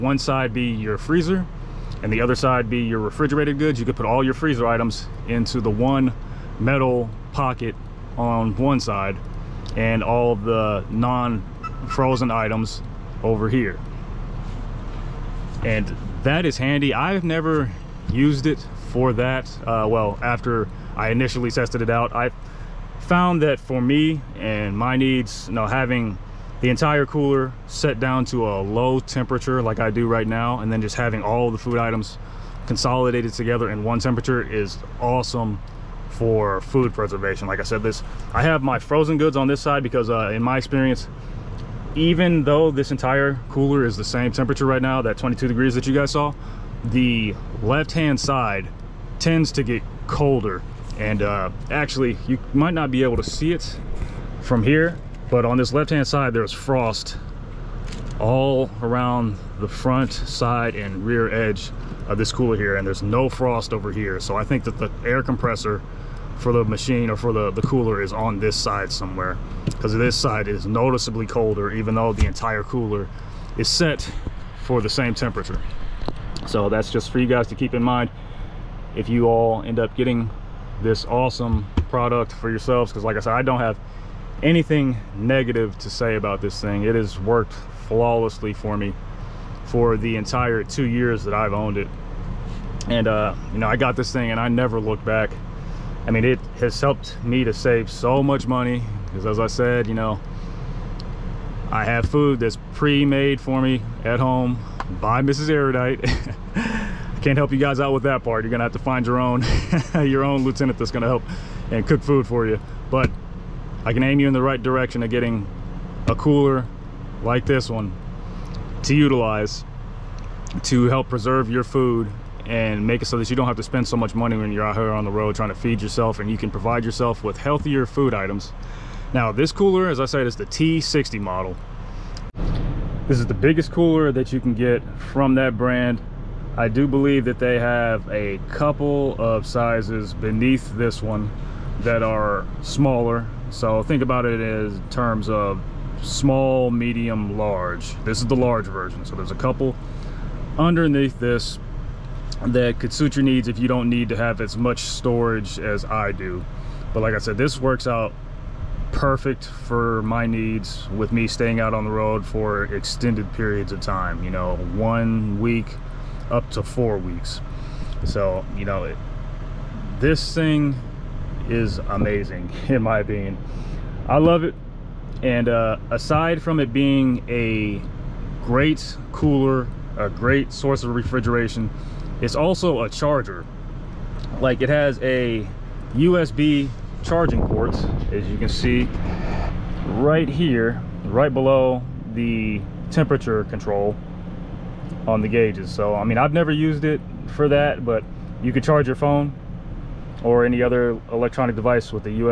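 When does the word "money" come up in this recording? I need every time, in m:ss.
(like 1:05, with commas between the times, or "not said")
1:38, 2:04.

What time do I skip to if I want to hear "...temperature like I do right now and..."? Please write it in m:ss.
0:28.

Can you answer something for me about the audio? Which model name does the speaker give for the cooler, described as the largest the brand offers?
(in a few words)
T60.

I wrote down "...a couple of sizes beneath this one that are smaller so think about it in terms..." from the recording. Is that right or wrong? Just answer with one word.
right.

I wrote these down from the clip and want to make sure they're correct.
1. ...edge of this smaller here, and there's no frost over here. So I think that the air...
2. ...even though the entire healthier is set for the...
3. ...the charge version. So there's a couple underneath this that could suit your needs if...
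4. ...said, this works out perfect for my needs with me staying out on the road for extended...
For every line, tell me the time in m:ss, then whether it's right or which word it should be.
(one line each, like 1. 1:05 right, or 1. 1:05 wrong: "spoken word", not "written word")
1. 1:01 wrong: "cooler", not "smaller"
2. 1:11 wrong: "cooler", not "healthier"
3. 2:28 wrong: "large", not "charge"
4. 2:37 right.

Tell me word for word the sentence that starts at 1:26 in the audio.
It has worked flawlessly for me for the entire two years that I've owned it.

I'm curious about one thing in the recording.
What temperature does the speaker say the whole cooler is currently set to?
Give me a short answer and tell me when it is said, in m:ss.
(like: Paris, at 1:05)
22 degrees, at 0:45.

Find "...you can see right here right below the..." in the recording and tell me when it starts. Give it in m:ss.
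3:08.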